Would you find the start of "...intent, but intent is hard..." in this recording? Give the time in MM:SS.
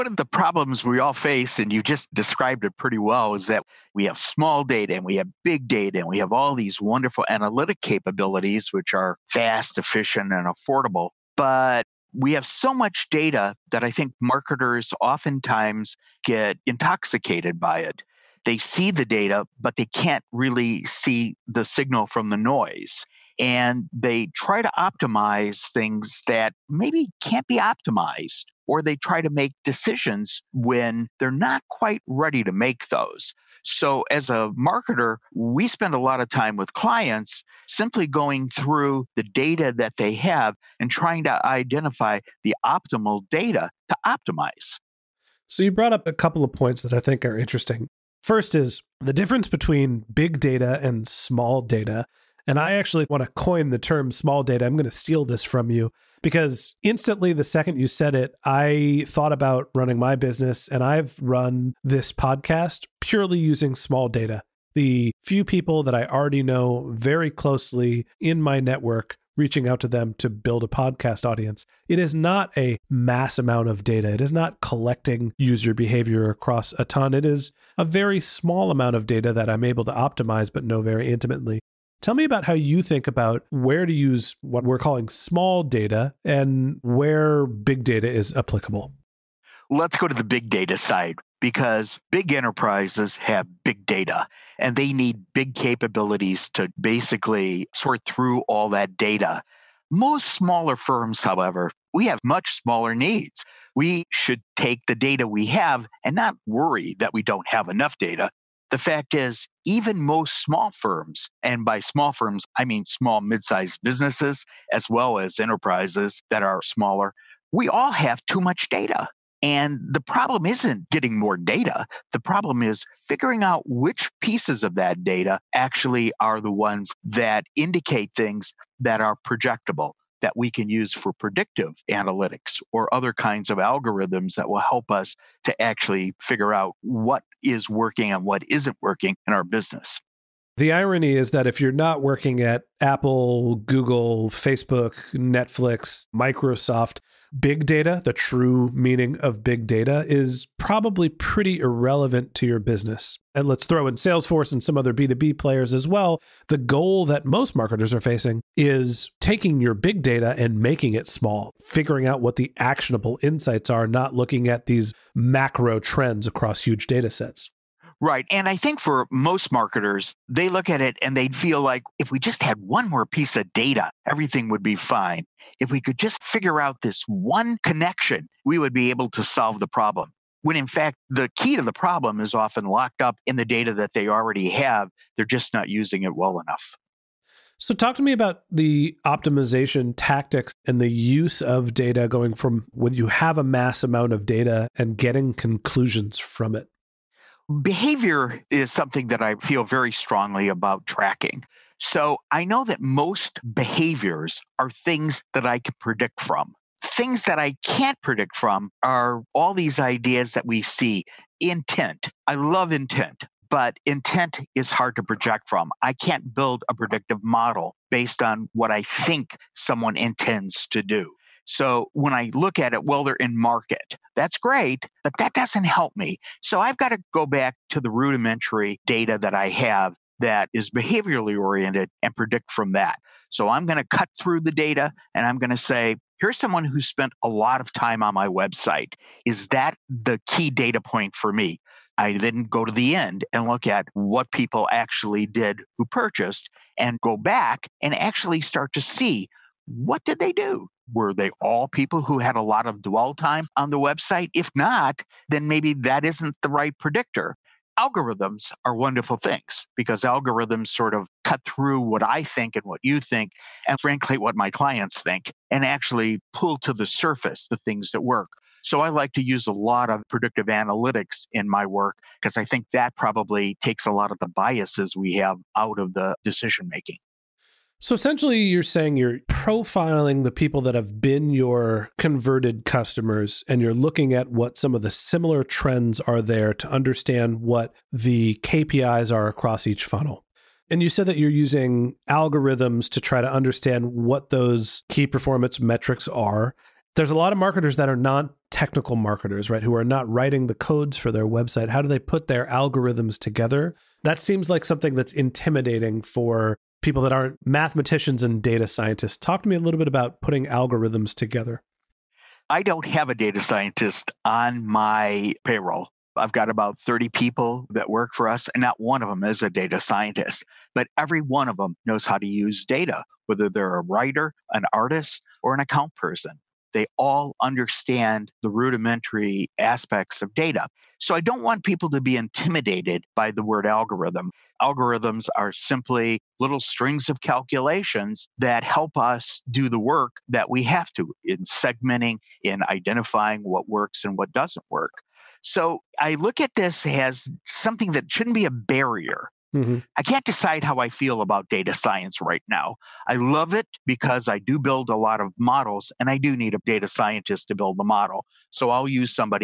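03:32.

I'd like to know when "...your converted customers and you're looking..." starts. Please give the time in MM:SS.
04:41.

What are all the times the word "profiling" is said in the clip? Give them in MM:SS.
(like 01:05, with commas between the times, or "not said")
04:39.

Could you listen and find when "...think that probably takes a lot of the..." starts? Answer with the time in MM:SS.
04:32.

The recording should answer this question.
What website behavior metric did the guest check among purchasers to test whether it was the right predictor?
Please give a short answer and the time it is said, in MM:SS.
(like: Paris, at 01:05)
dwell time, at 04:12.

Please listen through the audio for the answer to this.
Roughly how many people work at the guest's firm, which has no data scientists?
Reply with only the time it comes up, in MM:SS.
05:16.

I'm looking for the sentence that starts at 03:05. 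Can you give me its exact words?
They're just not using it well enough.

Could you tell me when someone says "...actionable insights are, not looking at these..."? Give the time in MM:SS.
02:42.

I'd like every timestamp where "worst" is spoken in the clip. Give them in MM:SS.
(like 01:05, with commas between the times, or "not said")
not said.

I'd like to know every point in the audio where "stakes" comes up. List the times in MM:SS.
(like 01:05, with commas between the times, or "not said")
not said.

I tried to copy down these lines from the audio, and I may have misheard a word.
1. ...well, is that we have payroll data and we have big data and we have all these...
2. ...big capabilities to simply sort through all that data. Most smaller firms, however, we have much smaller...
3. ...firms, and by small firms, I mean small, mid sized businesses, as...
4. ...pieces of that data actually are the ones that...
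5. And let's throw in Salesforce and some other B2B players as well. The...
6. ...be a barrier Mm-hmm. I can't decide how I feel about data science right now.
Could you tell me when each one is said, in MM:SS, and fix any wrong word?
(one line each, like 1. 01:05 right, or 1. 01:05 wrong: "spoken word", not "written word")
1. 00:02 wrong: "small", not "payroll"
2. 01:35 wrong: "basically", not "simply"
3. 01:50 right
4. 02:04 right
5. 02:33 right
6. 05:48 right.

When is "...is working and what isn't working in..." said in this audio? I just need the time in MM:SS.
02:17.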